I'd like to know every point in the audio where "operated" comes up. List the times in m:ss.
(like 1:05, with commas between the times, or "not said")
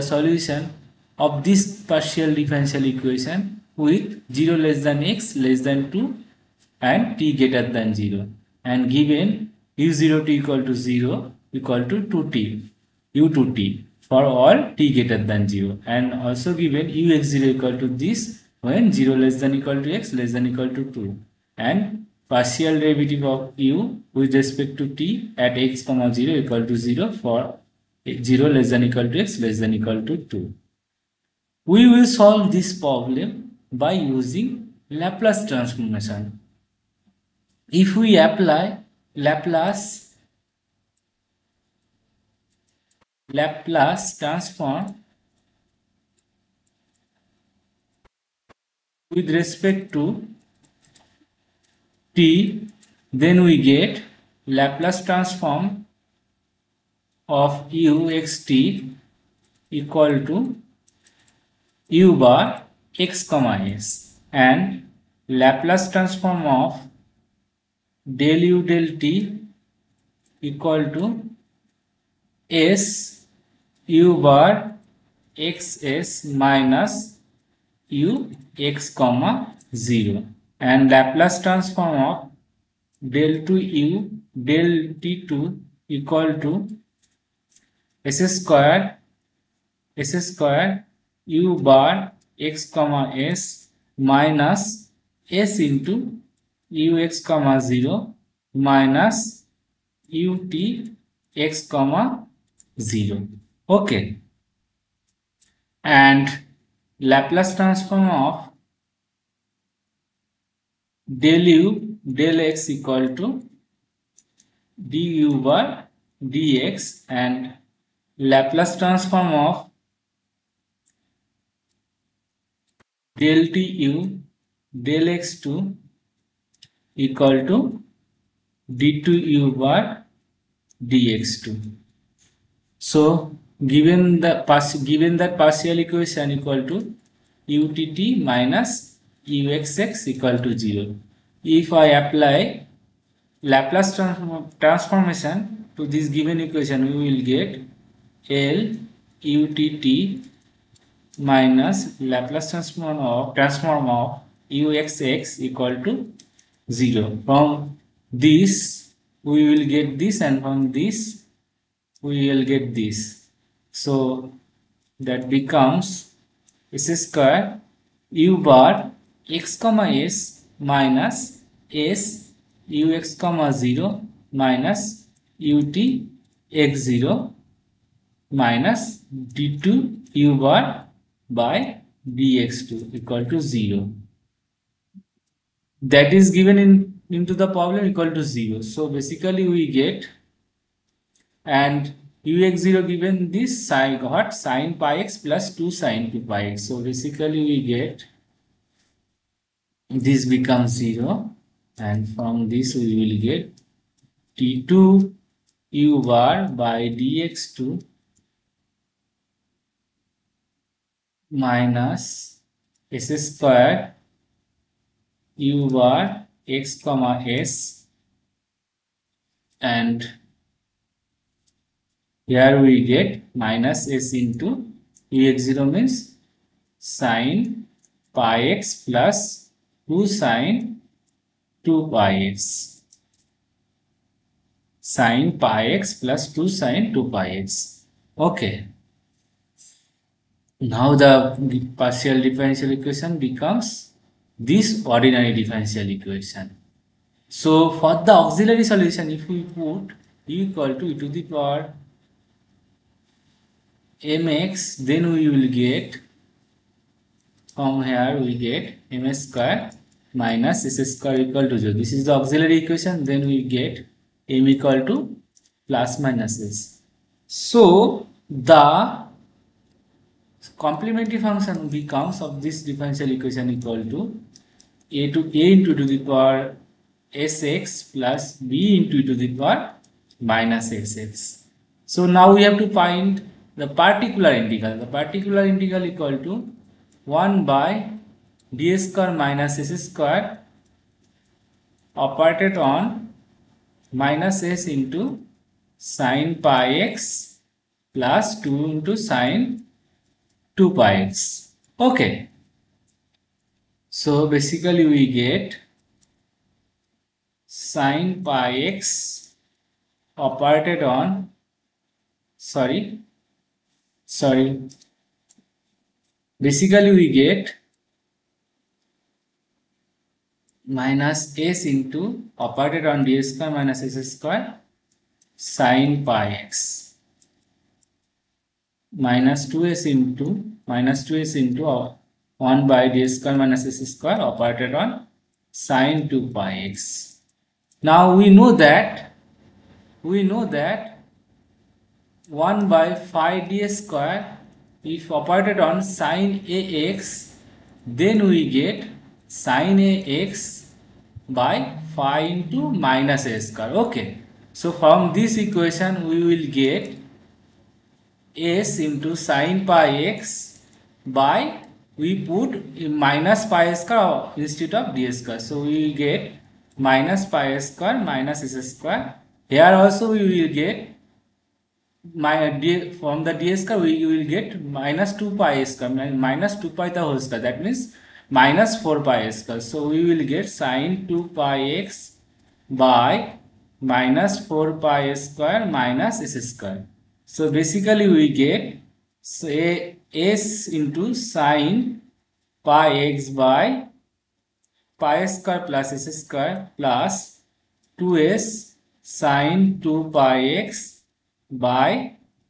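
4:51, 5:10, 5:22, 5:34, 5:45.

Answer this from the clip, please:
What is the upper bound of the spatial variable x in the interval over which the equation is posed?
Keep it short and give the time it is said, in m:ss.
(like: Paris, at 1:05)
2, at 0:04.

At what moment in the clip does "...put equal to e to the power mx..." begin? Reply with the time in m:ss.
4:09.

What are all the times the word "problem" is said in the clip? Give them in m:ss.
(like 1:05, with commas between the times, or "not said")
0:32, 3:07.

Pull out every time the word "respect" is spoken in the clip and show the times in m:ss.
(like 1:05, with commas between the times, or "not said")
0:24, 0:49.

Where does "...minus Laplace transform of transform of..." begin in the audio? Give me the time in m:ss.
2:31.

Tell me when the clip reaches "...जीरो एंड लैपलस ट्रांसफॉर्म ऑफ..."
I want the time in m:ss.
1:19.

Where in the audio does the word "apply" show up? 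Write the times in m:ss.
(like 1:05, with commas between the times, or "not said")
0:38, 2:22.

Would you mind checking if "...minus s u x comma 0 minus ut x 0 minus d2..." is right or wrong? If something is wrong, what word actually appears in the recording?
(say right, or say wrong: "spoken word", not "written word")
right.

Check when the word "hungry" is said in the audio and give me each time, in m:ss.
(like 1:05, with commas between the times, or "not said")
not said.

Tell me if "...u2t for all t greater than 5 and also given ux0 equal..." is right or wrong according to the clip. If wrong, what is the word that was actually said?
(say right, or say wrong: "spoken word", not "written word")
wrong: "0", not "5".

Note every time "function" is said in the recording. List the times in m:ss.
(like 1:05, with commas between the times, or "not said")
4:31.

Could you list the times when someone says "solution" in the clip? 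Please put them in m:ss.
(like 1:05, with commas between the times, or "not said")
0:00, 4:08.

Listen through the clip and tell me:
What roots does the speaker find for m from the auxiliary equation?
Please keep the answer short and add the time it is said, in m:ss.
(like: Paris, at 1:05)
plus minus s, at 4:24.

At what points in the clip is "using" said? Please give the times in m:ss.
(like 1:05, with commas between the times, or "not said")
0:33.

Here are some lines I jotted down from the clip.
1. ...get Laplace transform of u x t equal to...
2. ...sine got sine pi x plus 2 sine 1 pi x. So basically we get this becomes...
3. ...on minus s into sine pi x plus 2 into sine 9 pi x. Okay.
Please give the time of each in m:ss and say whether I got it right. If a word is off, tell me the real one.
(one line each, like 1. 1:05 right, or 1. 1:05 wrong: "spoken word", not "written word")
1. 0:53 right
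2. 3:13 wrong: "2", not "1"
3. 4:52 wrong: "2", not "9".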